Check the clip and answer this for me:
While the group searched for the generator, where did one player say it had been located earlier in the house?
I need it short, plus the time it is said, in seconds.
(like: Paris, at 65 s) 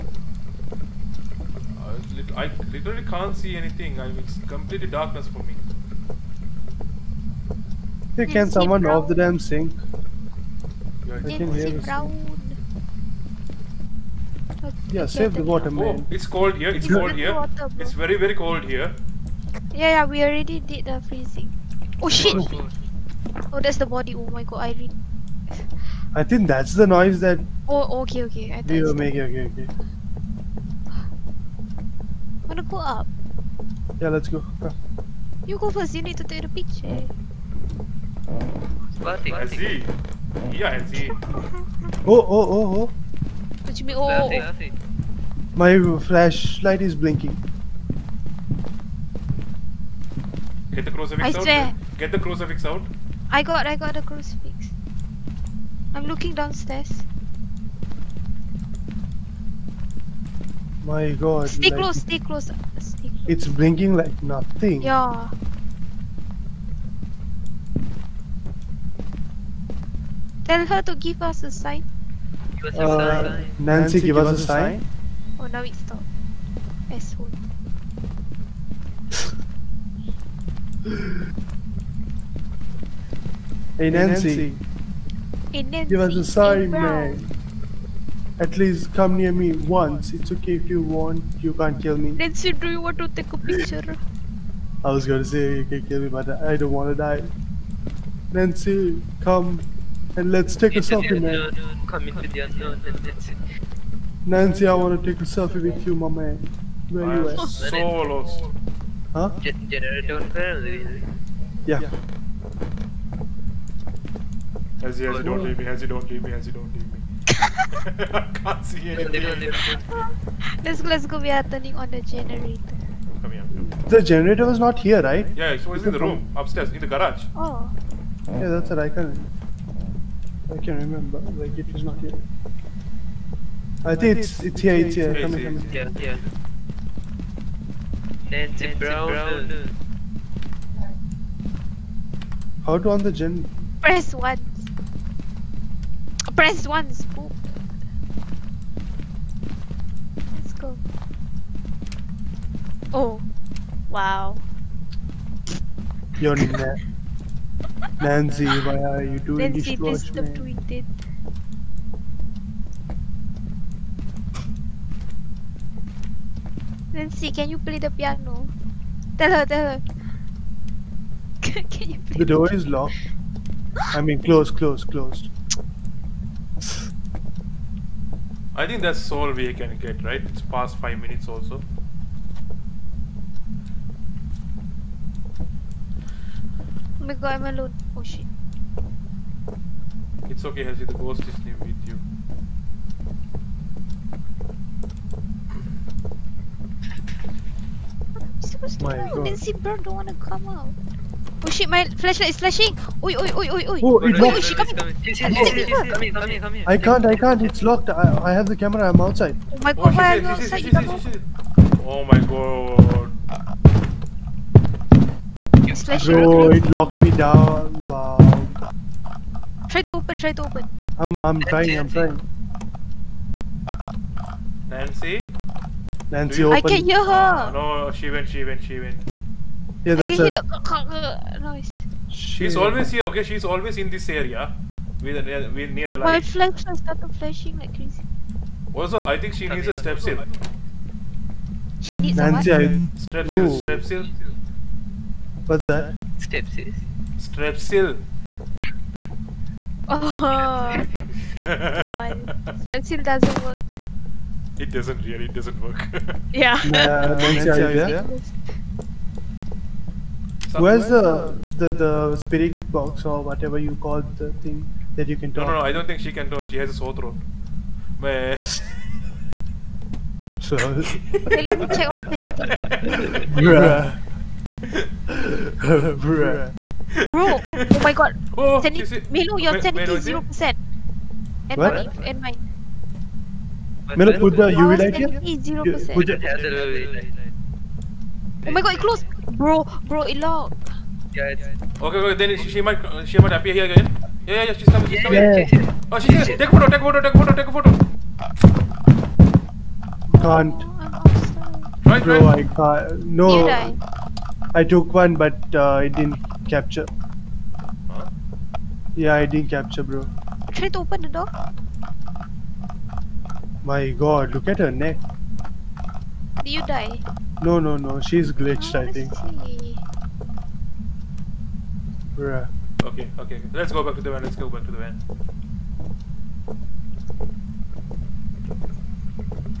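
the garage, at 126 s.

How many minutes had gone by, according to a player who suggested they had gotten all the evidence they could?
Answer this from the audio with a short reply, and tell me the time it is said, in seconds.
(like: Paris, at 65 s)
5 minutes, at 180 s.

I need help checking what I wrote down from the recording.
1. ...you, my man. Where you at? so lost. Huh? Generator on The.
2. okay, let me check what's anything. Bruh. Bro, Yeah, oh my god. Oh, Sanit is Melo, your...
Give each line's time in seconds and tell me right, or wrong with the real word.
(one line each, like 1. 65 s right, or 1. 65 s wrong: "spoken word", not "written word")
1. 105 s wrong: "Yeah", not "The"
2. 270 s wrong: "Bro", not "Yeah".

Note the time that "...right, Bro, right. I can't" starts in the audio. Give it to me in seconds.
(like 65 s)
301 s.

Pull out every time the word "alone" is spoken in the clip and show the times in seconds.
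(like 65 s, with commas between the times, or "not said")
187 s.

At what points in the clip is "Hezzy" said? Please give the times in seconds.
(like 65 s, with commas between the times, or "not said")
40 s.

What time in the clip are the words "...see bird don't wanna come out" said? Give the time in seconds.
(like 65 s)
199 s.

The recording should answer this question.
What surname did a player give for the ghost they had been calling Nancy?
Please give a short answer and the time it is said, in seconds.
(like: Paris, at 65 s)
Brown, at 138 s.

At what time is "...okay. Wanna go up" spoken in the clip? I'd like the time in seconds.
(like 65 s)
29 s.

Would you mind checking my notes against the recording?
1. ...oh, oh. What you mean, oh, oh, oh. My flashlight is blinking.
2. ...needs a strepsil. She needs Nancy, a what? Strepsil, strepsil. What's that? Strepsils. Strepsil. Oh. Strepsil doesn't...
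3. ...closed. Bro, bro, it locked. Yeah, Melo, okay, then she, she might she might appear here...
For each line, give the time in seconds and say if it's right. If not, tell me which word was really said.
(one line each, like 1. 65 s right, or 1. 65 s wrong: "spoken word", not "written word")
1. 42 s right
2. 239 s right
3. 288 s wrong: "Okay", not "Melo".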